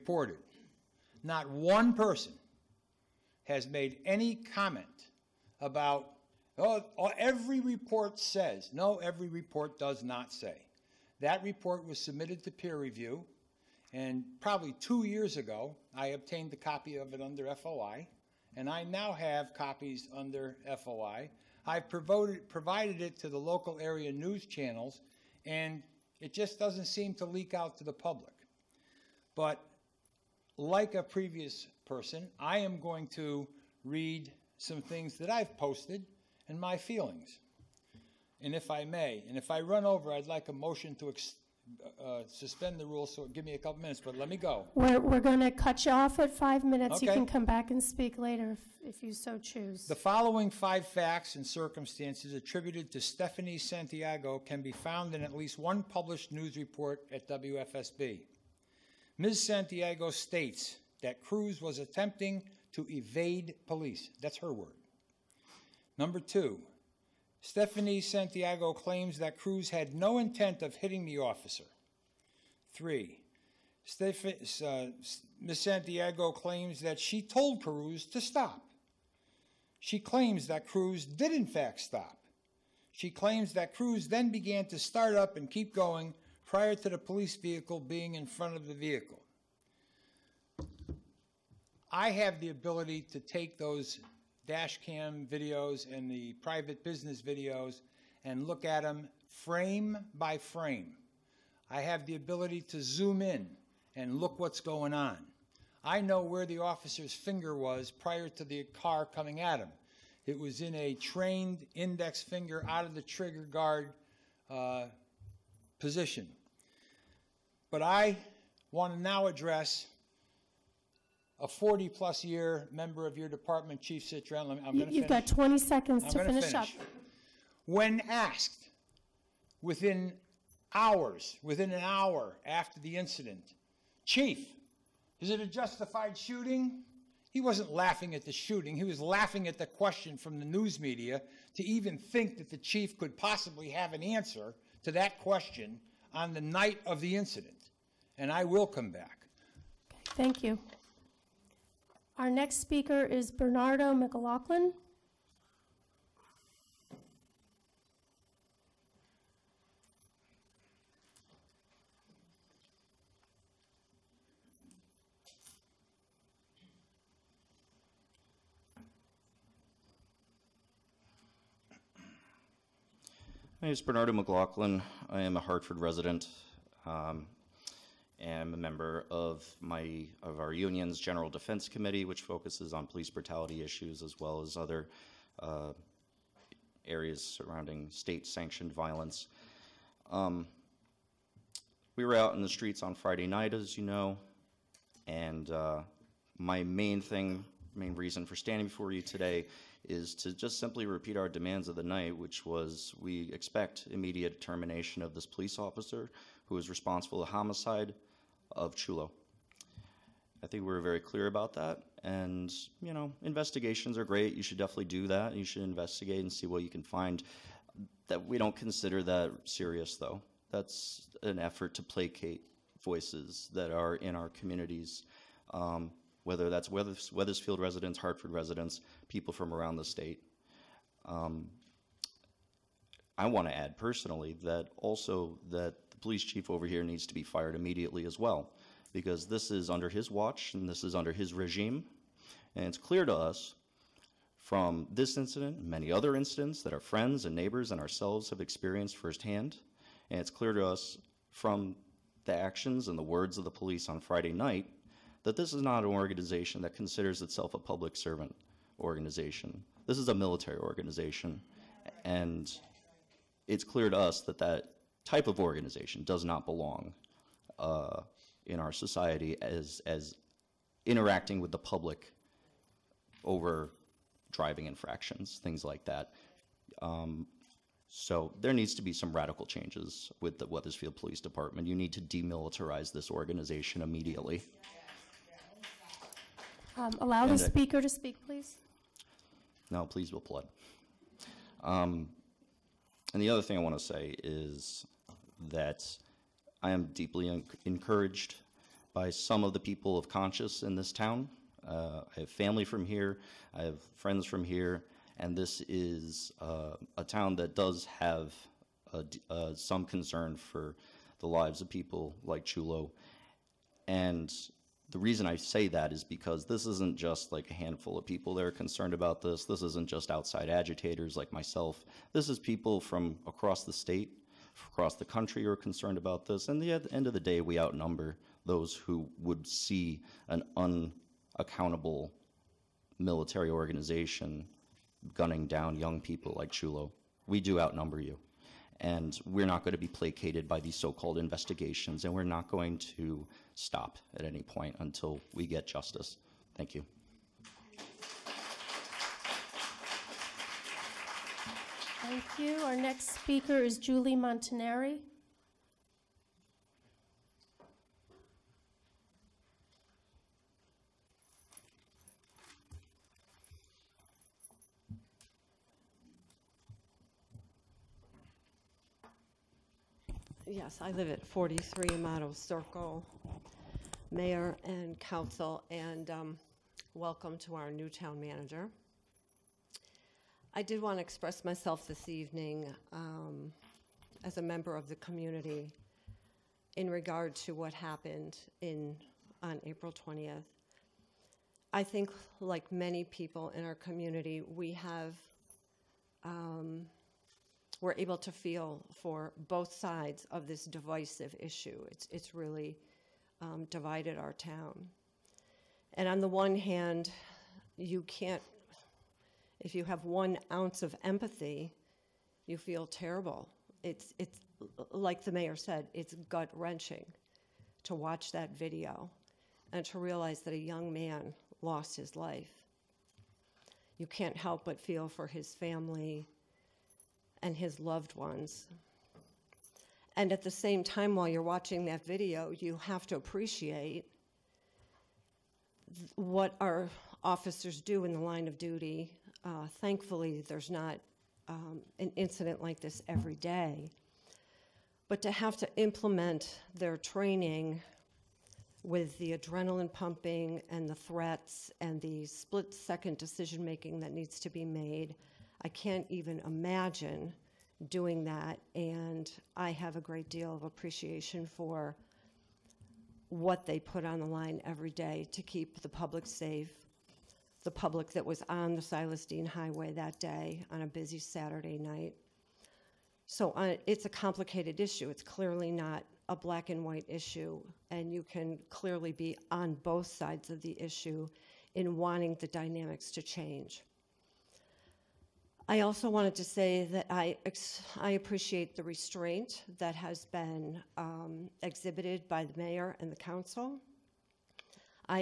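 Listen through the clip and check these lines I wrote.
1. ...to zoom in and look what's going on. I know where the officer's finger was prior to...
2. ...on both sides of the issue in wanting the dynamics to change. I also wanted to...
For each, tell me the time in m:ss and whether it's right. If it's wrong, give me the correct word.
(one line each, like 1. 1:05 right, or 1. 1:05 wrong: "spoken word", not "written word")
1. 1:42 right
2. 7:59 right.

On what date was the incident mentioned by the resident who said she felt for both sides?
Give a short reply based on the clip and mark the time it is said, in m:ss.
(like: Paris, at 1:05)
April 20th, at 6:29.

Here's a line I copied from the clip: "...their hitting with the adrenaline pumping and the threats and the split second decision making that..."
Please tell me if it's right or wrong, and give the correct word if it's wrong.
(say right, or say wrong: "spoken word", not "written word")
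wrong: "training", not "hitting".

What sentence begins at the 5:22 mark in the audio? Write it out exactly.
This is people from across the state across the country are concerned about this.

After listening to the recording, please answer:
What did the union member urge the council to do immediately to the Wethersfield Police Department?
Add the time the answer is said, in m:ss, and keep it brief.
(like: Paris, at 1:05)
Demilitarize, at 4:42.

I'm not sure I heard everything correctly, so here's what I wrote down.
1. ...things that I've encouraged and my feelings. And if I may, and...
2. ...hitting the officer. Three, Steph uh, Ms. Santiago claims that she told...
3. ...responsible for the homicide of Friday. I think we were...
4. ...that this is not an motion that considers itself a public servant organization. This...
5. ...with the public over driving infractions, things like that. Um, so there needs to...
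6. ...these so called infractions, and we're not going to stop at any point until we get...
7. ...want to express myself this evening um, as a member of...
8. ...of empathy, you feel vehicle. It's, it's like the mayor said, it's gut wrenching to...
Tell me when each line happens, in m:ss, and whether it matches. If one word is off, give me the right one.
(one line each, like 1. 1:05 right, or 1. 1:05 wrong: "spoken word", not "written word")
1. 0:34 wrong: "posted", not "encouraged"
2. 1:10 right
3. 3:26 wrong: "Chulo", not "Friday"
4. 4:15 wrong: "organization", not "motion"
5. 4:31 right
6. 5:40 wrong: "investigations", not "infractions"
7. 6:20 right
8. 6:50 wrong: "terrible", not "vehicle".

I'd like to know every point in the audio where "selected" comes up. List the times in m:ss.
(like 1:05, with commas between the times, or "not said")
not said.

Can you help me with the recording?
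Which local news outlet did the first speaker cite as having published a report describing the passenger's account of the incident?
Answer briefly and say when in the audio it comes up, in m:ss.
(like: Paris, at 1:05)
WFSB, at 0:57.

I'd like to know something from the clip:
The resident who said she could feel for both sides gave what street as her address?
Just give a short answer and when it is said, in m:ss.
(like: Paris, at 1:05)
Amato Circle, at 6:11.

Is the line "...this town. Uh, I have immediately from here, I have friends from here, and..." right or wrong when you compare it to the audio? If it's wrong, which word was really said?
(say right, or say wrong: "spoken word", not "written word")
wrong: "family", not "immediately".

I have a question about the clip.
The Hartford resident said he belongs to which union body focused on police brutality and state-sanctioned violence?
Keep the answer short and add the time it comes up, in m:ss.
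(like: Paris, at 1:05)
General Defense Committee, at 3:00.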